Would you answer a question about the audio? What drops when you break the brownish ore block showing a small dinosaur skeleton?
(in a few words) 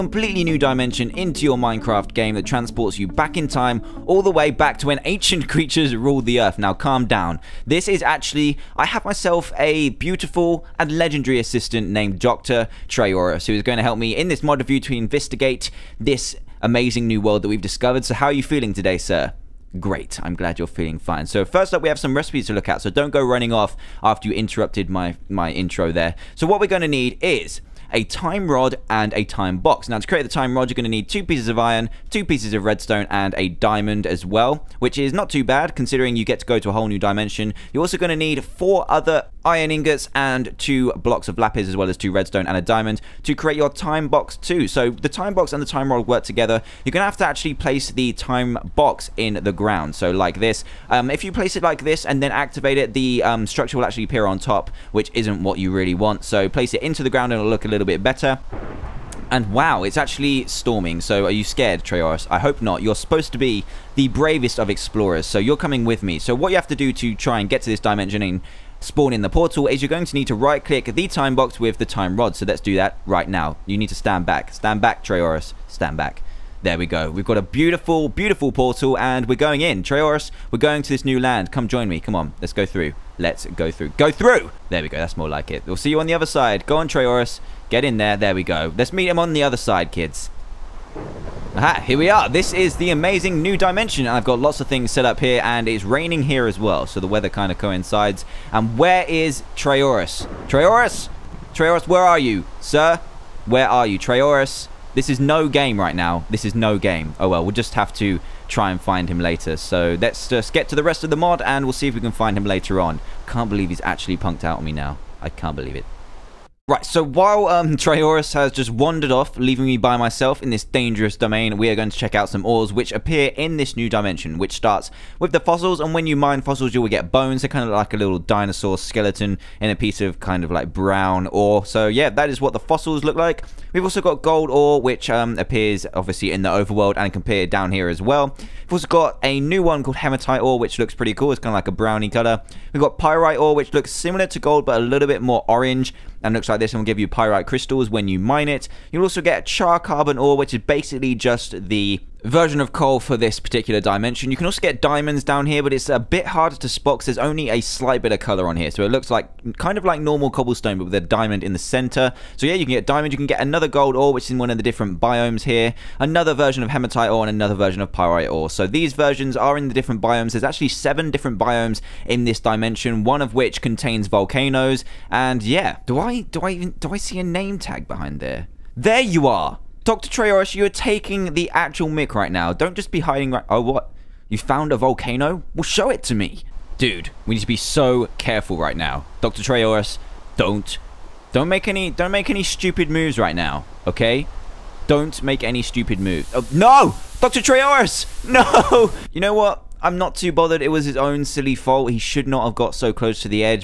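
Bones.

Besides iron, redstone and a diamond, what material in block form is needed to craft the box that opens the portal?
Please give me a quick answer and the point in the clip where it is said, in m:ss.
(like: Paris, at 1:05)
Lapis, at 0:40.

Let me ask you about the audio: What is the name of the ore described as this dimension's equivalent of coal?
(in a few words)
Char carbon ore.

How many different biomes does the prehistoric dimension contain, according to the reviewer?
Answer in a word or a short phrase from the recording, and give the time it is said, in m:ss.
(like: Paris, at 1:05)
7, at 2:50.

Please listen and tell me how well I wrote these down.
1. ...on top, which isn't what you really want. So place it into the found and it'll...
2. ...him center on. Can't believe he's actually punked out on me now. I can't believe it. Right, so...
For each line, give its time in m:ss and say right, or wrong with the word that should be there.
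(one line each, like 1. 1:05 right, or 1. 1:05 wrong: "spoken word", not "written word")
1. 0:54 wrong: "ground", not "found"
2. 1:52 wrong: "later", not "center".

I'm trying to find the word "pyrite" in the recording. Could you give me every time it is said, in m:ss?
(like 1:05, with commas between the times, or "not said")
2:22, 2:27, 2:47.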